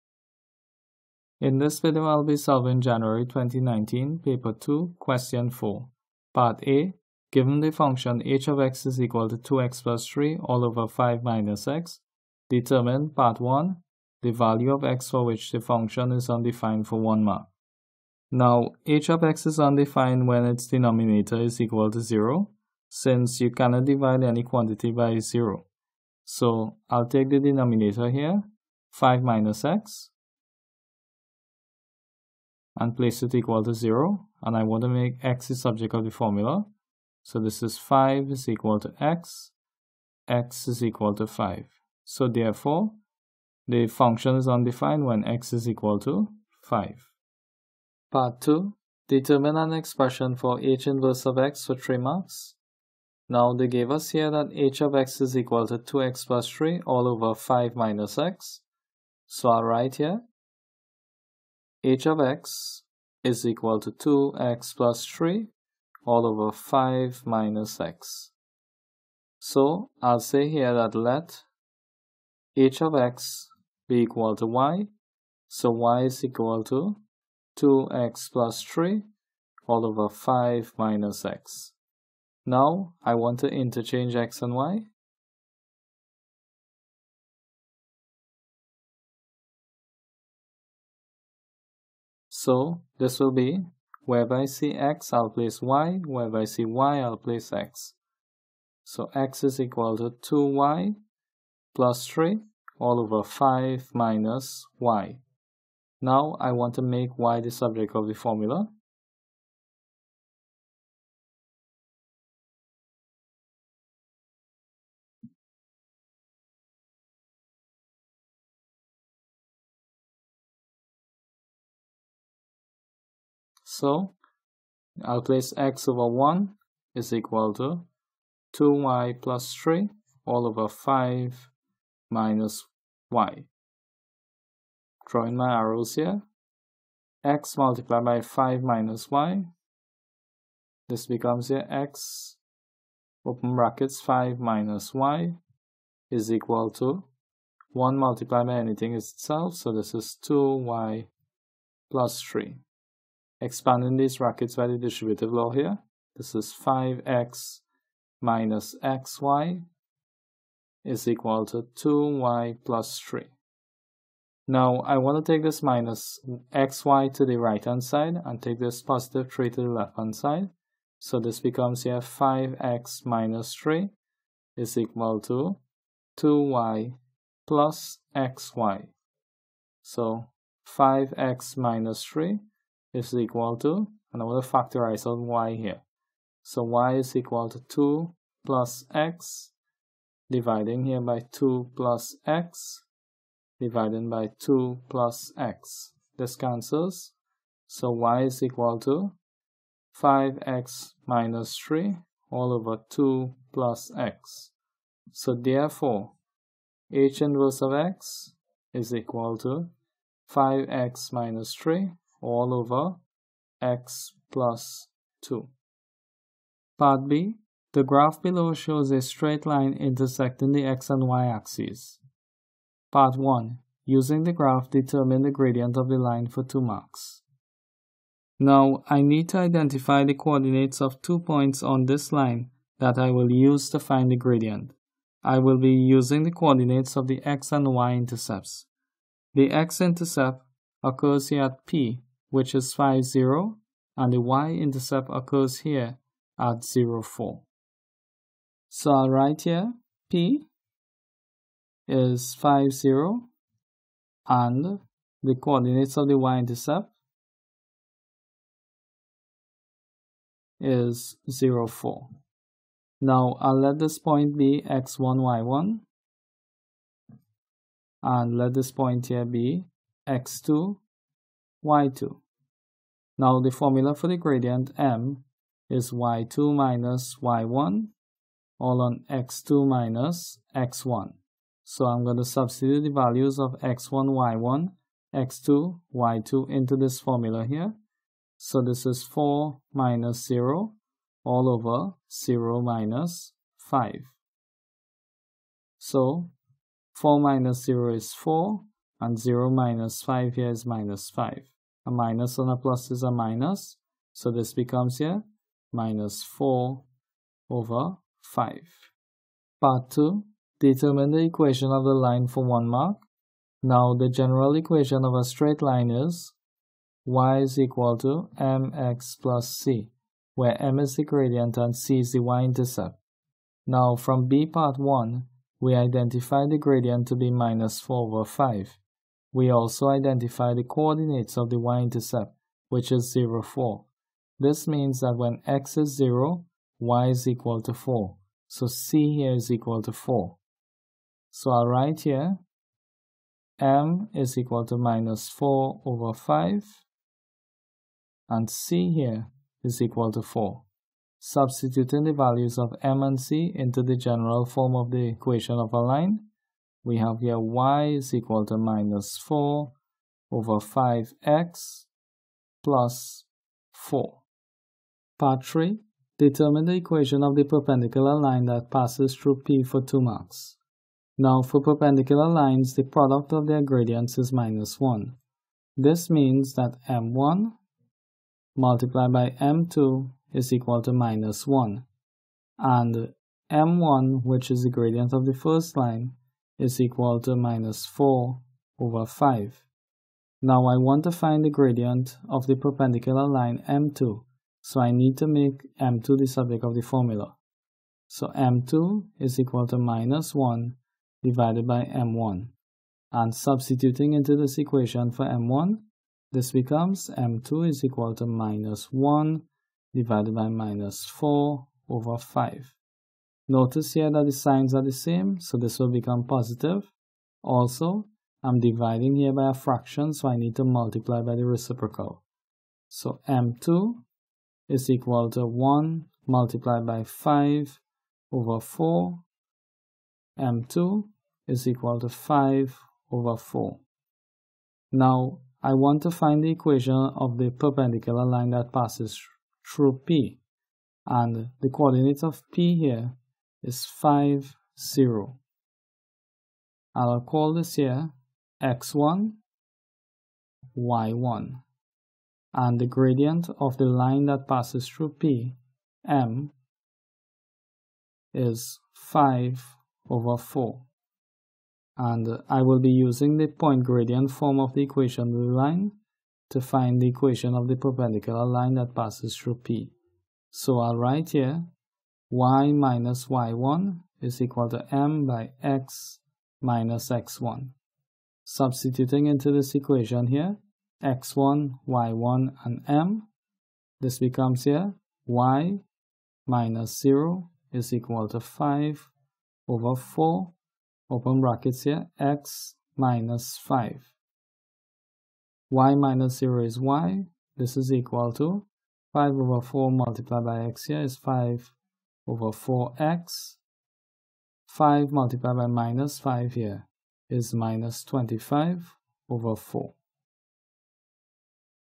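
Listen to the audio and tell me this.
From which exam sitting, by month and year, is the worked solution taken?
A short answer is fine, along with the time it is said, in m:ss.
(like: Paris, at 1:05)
January 2019, at 0:02.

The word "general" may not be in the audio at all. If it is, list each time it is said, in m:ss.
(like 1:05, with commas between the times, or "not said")
5:14, 5:53.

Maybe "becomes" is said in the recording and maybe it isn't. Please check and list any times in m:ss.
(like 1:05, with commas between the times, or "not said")
2:21, 2:51, 5:04, 6:46, 6:55, 8:04.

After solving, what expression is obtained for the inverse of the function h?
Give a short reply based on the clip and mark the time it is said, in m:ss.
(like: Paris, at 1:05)
(5x - 3)/(x + 2), at 3:30.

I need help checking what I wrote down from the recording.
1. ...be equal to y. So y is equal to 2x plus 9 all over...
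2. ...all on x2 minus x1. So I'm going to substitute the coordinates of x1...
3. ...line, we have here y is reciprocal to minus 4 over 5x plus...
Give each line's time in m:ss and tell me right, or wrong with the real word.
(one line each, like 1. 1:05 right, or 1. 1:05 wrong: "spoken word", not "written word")
1. 1:13 wrong: "3", not "9"
2. 4:38 wrong: "values", not "coordinates"
3. 5:55 wrong: "equal", not "reciprocal".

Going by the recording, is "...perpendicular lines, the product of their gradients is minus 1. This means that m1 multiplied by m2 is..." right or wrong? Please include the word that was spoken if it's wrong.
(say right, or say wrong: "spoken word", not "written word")
right.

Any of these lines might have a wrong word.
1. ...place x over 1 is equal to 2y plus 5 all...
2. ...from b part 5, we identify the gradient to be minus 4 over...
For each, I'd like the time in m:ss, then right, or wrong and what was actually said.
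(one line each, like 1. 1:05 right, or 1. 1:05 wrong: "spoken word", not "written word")
1. 2:05 wrong: "3", not "5"
2. 5:23 wrong: "1", not "5".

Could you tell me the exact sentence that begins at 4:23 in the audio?
Now I'll let this point be x1, y1, and let this point here be x2, y2.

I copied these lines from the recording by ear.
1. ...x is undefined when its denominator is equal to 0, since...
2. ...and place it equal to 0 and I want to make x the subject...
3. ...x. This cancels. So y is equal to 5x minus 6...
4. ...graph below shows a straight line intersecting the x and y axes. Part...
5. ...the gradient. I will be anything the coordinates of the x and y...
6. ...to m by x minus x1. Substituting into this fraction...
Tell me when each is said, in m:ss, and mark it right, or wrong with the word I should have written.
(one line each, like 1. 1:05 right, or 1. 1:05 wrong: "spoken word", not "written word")
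1. 0:19 right
2. 0:32 right
3. 3:15 wrong: "3", not "6"
4. 3:37 right
5. 3:54 wrong: "using", not "anything"
6. 7:54 wrong: "equation", not "fraction".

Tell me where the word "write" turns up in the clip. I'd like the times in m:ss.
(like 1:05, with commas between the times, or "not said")
0:59, 4:09, 5:41, 7:50.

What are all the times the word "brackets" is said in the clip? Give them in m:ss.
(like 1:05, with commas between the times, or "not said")
2:23, 2:34, 8:11.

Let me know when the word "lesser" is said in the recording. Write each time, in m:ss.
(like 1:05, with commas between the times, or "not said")
not said.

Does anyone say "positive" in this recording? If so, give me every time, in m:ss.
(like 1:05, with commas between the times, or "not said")
2:48, 6:56.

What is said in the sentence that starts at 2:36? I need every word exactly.
This is 5x minus xy is equal to 2y plus 3.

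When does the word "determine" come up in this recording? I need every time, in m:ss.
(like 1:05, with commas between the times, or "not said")
0:12, 0:49, 3:44, 5:10, 6:06.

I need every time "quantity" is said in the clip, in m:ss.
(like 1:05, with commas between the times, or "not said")
0:24.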